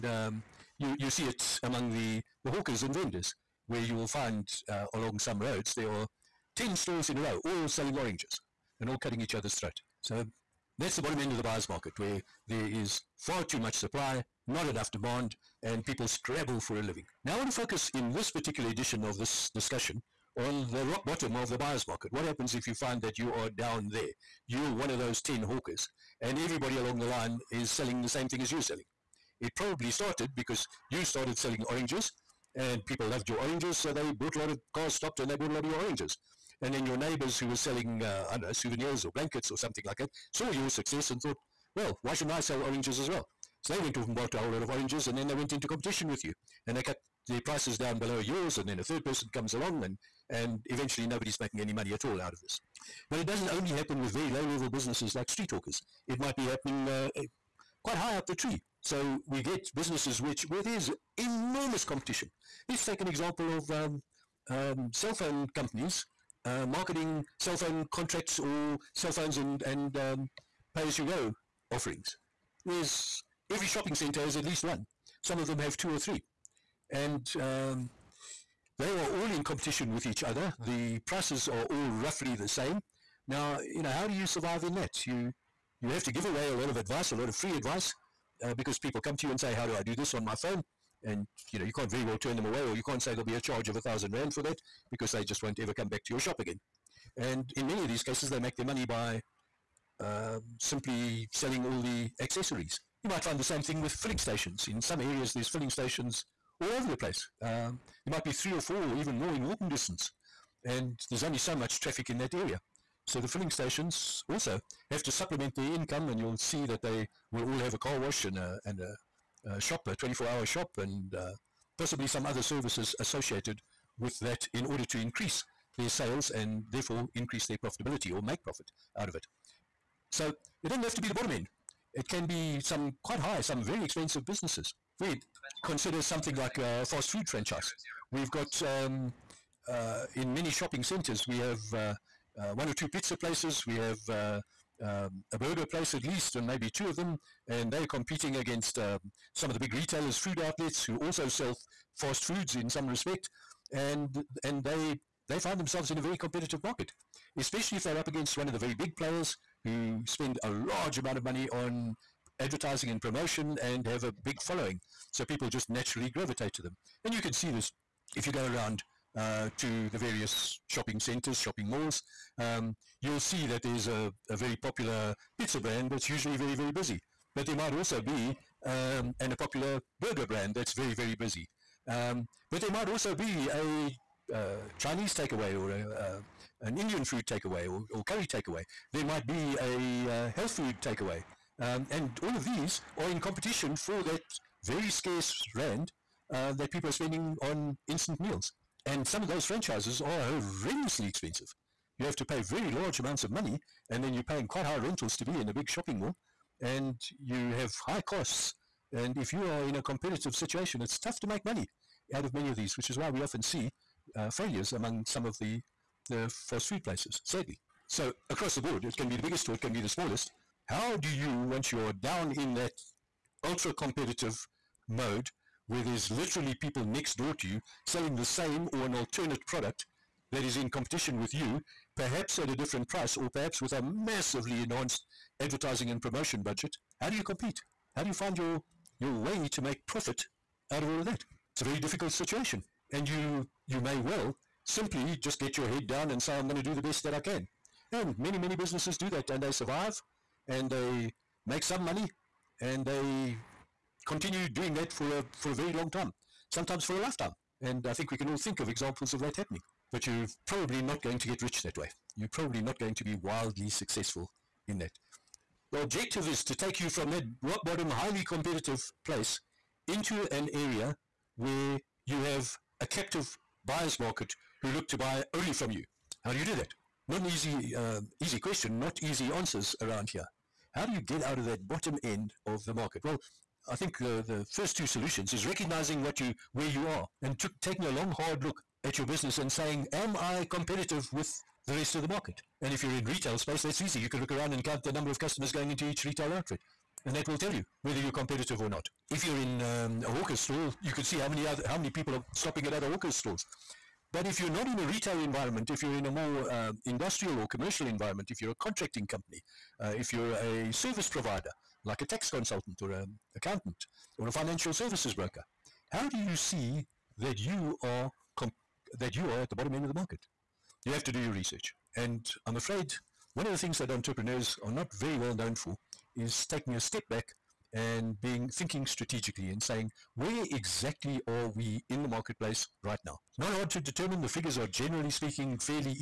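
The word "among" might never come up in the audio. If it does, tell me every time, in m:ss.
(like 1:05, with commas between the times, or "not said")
0:01, 3:34.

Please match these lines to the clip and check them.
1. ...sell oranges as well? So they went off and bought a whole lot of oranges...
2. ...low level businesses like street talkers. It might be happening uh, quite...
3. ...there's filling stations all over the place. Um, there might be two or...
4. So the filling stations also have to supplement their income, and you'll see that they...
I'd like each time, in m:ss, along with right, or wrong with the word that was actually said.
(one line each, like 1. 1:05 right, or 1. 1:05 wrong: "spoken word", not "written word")
1. 0:42 right
2. 0:54 right
3. 1:45 wrong: "three", not "two"
4. 1:53 right.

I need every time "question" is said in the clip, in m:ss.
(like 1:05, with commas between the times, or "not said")
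4:38.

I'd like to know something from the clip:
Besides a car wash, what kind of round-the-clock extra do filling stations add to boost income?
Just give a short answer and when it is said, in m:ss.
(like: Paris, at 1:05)
24 hour shop, at 1:59.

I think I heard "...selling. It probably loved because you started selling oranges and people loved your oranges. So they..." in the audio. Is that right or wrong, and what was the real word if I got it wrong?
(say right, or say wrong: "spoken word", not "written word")
wrong: "started", not "loved".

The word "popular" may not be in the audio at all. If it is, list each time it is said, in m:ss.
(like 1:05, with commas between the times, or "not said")
2:54, 2:59.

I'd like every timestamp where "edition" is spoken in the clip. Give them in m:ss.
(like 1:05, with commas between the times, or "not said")
0:18.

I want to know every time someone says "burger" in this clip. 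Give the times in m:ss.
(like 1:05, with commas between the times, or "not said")
2:25, 3:00.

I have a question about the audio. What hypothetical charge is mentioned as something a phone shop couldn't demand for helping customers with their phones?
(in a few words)
1000 rand.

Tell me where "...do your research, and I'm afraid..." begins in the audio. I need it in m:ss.
5:21.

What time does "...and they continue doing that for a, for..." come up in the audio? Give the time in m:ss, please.
4:12.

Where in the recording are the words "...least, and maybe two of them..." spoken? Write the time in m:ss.
2:26.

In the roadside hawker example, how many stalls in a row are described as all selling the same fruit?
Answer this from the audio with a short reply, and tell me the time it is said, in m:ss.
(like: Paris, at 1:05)
10, at 0:06.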